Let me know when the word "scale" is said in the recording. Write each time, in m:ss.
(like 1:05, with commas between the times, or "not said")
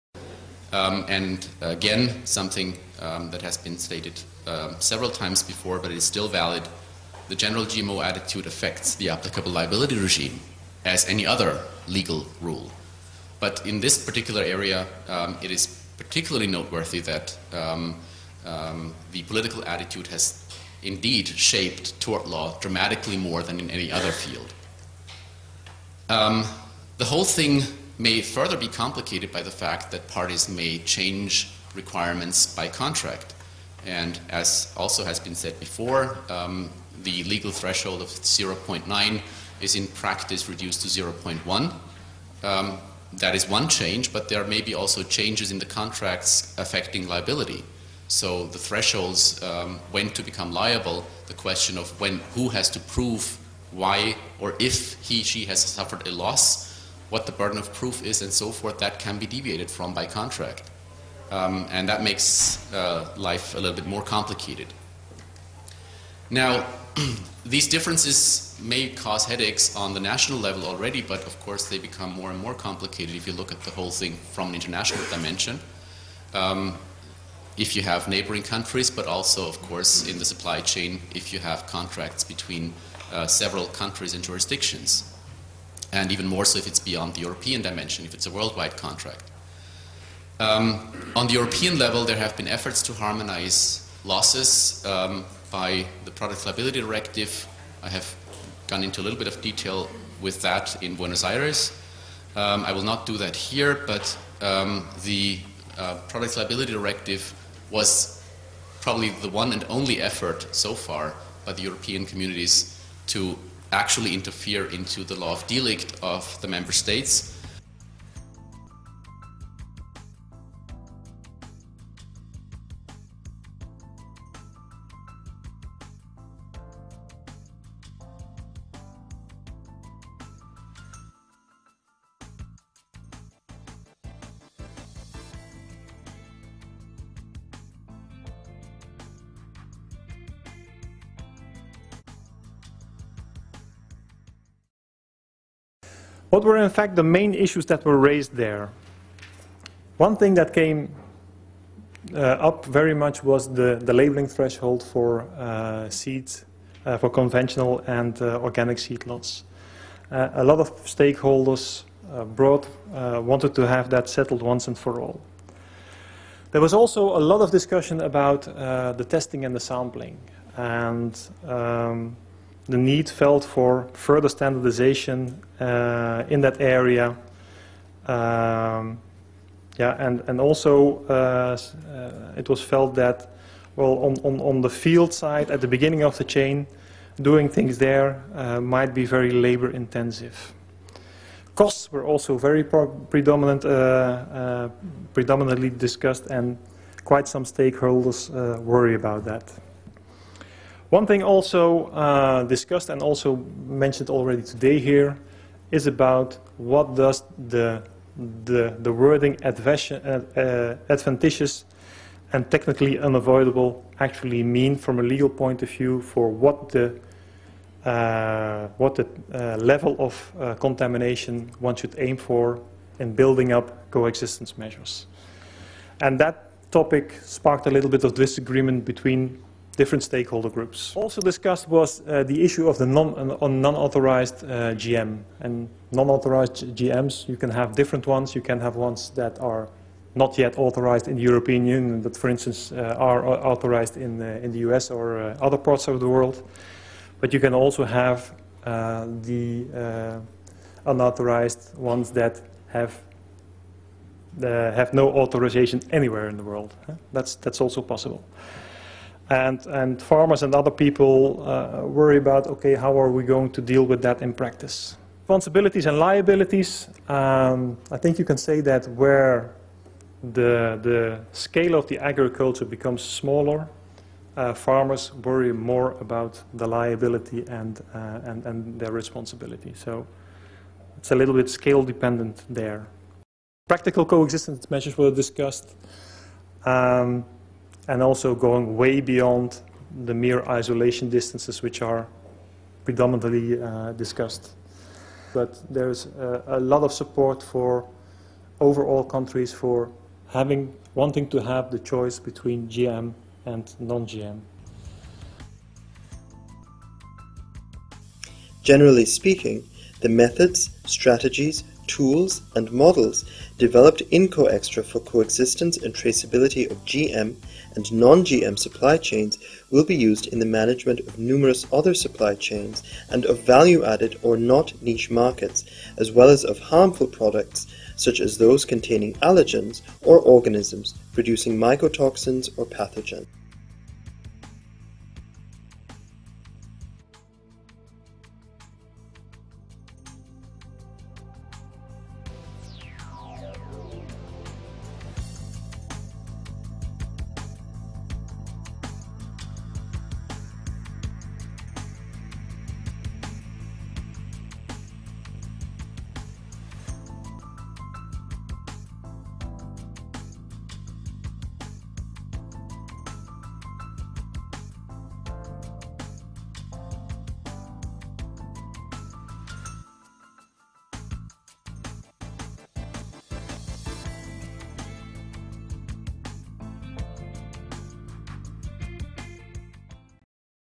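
4:31, 4:41.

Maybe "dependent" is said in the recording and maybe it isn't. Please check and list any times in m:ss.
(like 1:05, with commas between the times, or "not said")
4:41.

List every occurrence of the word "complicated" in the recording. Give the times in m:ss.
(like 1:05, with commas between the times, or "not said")
0:28, 1:04, 1:12.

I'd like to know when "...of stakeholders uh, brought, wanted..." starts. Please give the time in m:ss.
2:40.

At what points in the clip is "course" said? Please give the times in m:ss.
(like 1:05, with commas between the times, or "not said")
1:11, 1:19.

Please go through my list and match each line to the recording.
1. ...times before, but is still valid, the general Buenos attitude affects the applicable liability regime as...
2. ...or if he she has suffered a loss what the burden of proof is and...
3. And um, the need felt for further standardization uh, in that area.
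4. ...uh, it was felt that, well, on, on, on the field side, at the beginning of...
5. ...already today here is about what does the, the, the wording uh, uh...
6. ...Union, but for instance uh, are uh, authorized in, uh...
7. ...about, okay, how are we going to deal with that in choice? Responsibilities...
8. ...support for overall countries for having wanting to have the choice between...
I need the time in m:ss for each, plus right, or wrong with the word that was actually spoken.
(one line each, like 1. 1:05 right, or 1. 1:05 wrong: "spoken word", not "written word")
1. 0:05 wrong: "GMO", not "Buenos"
2. 0:54 right
3. 2:50 right
4. 3:01 right
5. 3:24 right
6. 4:01 right
7. 4:22 wrong: "practice", not "choice"
8. 4:56 right.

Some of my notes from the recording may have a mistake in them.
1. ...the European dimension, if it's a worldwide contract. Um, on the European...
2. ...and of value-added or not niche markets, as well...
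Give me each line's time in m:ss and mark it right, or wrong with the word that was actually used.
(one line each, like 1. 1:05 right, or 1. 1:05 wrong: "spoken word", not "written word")
1. 1:27 right
2. 5:23 right.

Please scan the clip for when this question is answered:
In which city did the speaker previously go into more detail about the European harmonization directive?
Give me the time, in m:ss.
1:40.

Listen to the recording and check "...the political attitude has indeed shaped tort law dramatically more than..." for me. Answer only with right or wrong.
right.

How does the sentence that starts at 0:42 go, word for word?
Um, that is one change, but there may be also changes in the contracts affecting liability.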